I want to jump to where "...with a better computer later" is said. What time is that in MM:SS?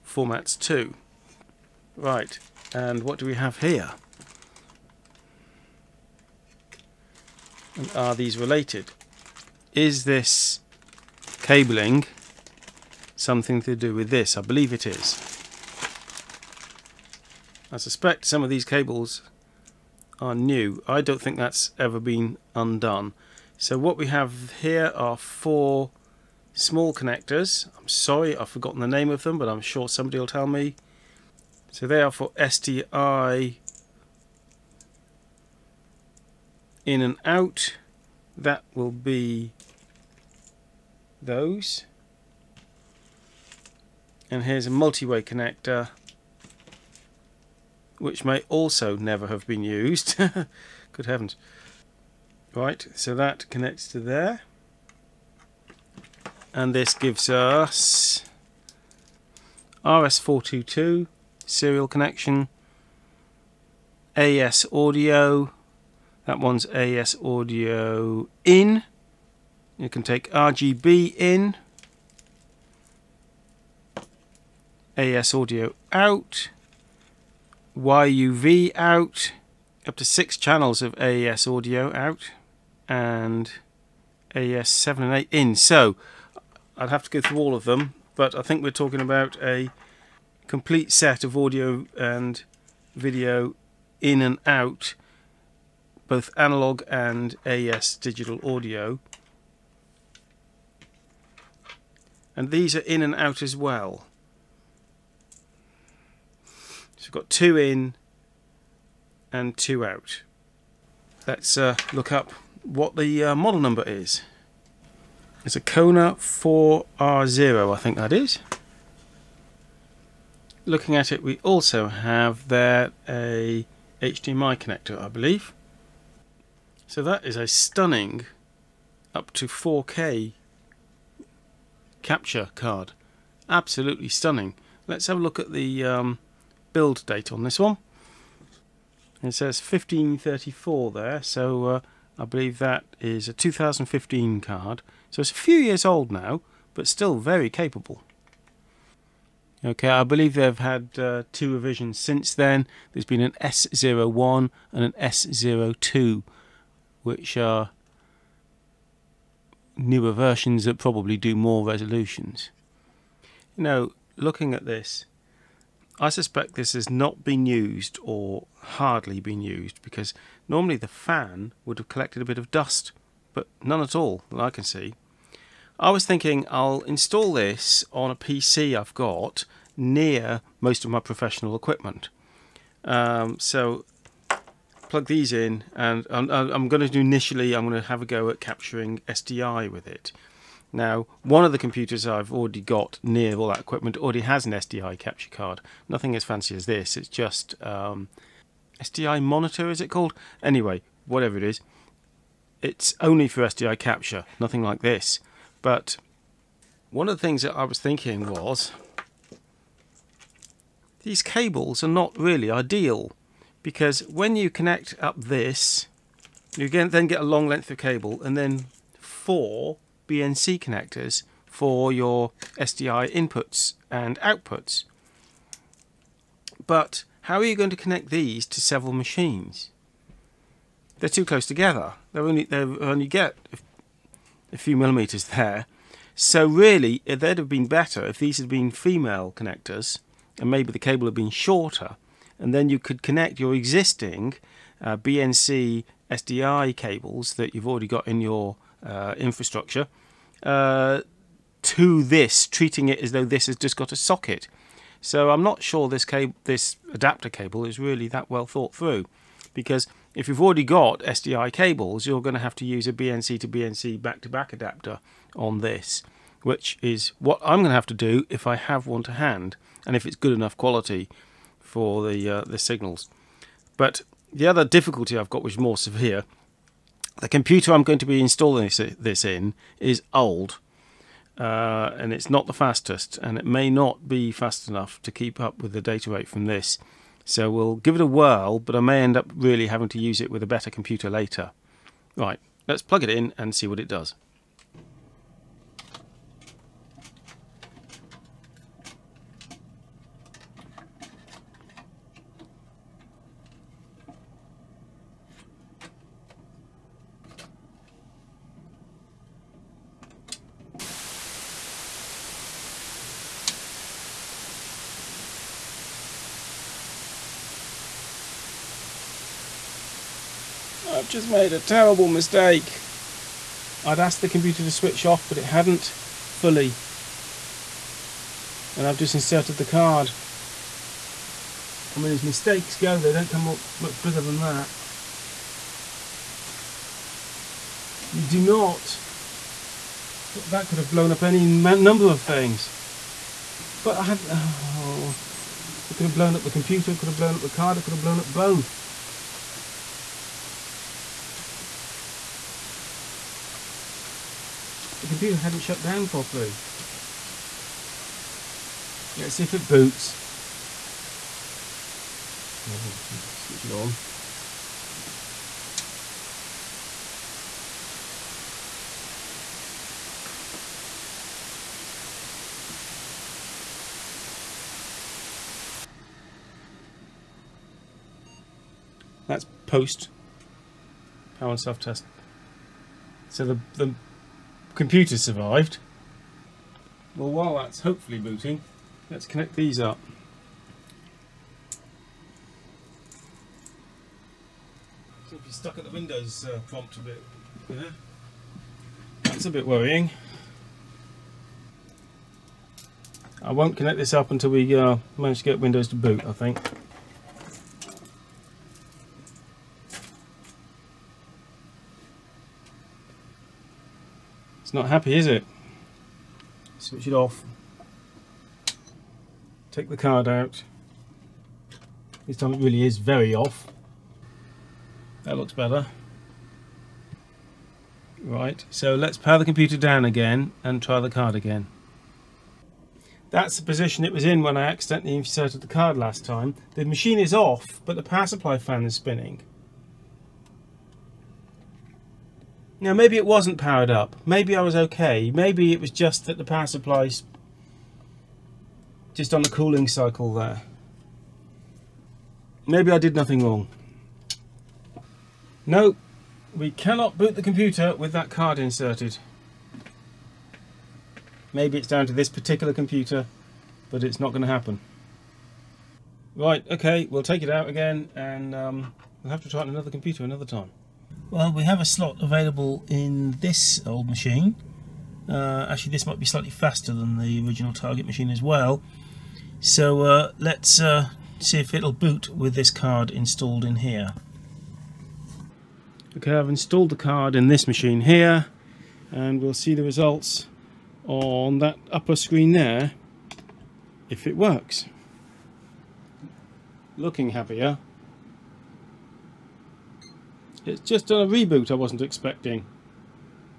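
04:50.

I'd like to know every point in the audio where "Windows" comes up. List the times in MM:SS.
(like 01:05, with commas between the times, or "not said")
06:35, 06:45.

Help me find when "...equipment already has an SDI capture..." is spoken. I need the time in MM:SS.
03:13.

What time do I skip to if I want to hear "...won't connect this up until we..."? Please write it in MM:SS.
06:43.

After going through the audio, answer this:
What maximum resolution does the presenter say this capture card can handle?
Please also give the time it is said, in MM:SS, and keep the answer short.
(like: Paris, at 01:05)
4K, at 02:09.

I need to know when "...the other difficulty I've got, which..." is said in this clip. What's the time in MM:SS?
04:34.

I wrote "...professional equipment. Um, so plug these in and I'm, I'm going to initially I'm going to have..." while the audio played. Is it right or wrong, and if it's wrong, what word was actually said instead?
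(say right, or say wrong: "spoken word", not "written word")
right.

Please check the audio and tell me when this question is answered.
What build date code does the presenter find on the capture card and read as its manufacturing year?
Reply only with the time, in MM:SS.
02:19.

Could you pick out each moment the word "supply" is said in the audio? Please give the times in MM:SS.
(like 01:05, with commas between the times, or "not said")
07:18, 07:26.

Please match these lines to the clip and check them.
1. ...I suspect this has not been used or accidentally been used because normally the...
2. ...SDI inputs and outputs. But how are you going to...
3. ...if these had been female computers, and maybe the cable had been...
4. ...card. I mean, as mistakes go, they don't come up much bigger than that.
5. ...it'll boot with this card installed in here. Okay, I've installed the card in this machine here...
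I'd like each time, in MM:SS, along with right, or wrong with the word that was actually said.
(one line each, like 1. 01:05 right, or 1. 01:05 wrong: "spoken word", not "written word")
1. 02:45 wrong: "hardly", not "accidentally"
2. 03:42 right
3. 03:58 wrong: "connectors", not "computers"
4. 05:29 right
5. 08:01 right.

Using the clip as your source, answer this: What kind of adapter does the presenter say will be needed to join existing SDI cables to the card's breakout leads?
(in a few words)
BNC to BNC back-to-back.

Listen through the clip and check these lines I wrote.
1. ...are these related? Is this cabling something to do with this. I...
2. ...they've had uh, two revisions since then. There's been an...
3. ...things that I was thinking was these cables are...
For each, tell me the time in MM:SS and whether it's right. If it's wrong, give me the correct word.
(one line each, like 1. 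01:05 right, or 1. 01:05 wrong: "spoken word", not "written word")
1. 00:07 right
2. 02:30 right
3. 03:27 right.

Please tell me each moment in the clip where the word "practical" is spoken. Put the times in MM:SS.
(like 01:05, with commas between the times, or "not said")
not said.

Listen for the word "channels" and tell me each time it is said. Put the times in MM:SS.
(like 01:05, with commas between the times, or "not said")
01:20.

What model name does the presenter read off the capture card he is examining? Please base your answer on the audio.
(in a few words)
Kona 4R0.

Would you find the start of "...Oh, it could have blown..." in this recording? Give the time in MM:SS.
05:44.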